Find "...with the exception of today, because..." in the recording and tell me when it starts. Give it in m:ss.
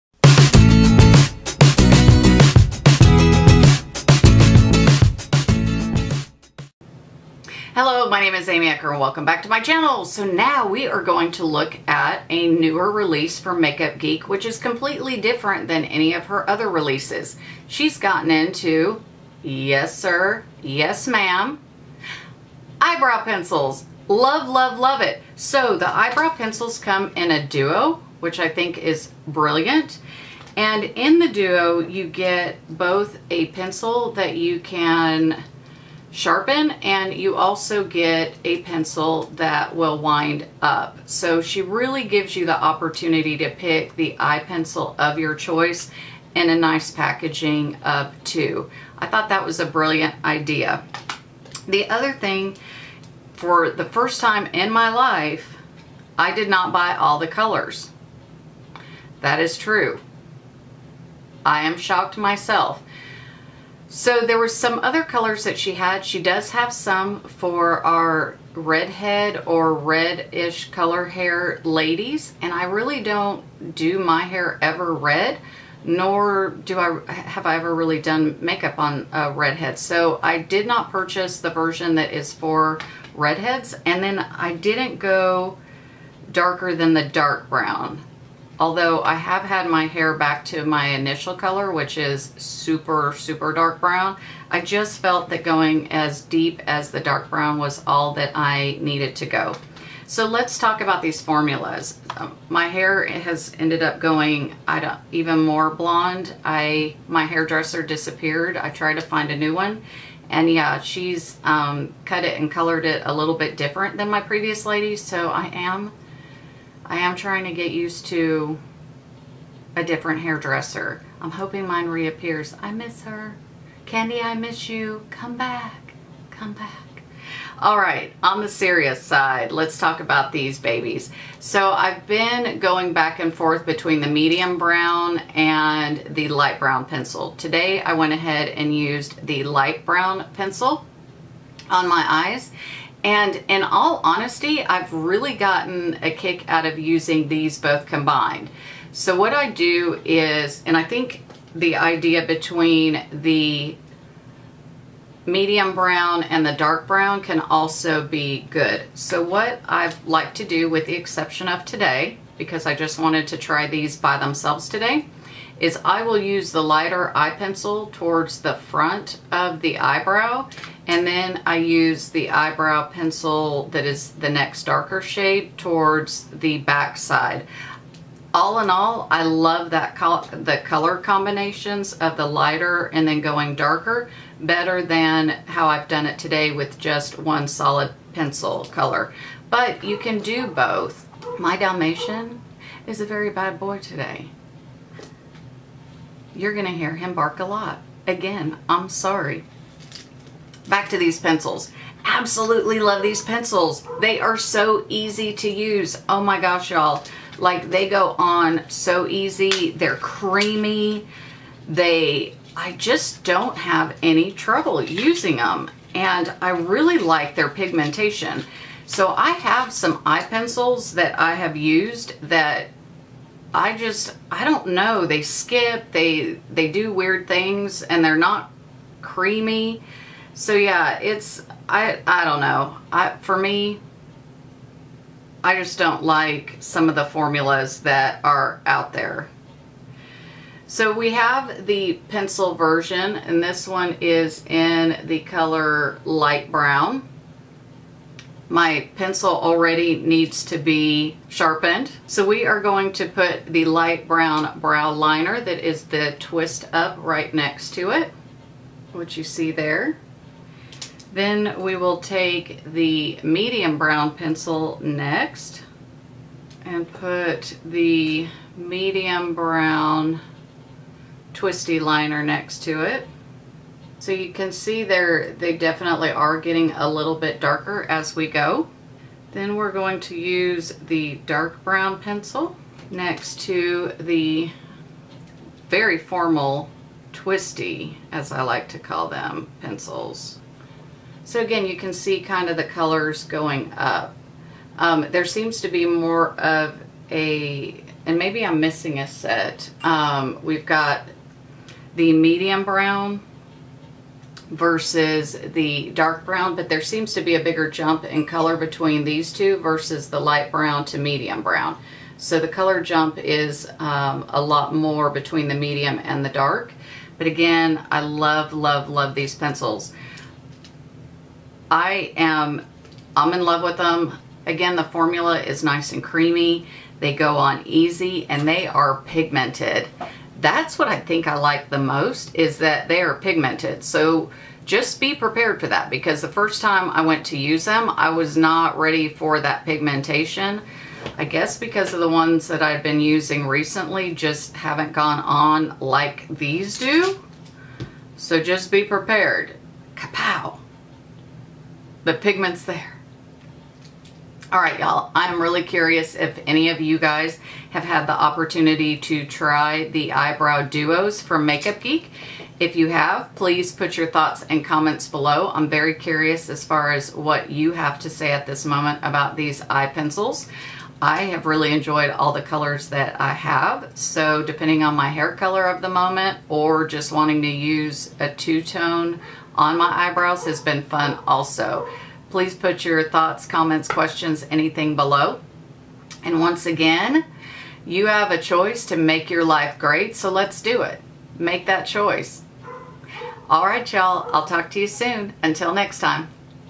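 2:40.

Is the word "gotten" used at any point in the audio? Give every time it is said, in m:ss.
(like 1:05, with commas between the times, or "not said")
0:17, 2:25.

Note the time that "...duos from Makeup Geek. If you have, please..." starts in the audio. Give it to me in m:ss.
6:00.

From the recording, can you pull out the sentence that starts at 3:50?
So yeah, it's, I, I don't know.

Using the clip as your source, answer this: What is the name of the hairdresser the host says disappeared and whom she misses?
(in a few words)
Candy.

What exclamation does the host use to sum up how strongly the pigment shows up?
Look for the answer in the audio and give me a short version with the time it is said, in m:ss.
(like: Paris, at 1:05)
Kapow, at 5:49.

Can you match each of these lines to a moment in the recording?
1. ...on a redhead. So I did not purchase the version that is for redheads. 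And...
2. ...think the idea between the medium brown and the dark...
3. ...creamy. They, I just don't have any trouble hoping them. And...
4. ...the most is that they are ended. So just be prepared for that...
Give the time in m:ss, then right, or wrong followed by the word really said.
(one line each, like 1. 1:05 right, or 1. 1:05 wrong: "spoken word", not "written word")
1. 1:18 right
2. 2:30 right
3. 3:29 wrong: "using", not "hoping"
4. 5:31 wrong: "pigmented", not "ended".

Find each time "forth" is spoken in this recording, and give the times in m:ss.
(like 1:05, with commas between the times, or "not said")
2:13.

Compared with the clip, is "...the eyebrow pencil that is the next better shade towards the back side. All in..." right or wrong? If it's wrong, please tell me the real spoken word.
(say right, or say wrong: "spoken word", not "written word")
wrong: "darker", not "better".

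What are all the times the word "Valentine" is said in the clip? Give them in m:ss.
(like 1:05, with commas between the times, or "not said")
not said.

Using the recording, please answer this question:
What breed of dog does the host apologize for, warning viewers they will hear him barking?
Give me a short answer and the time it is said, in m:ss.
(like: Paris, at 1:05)
Dalmatian, at 3:11.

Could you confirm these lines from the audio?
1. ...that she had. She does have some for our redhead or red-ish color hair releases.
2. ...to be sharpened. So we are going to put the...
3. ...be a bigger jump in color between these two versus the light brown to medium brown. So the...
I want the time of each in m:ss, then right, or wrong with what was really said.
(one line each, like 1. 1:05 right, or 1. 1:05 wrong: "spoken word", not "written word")
1. 1:05 wrong: "ladies", not "releases"
2. 4:10 right
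3. 5:07 right.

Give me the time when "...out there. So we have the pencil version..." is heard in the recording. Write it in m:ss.
3:58.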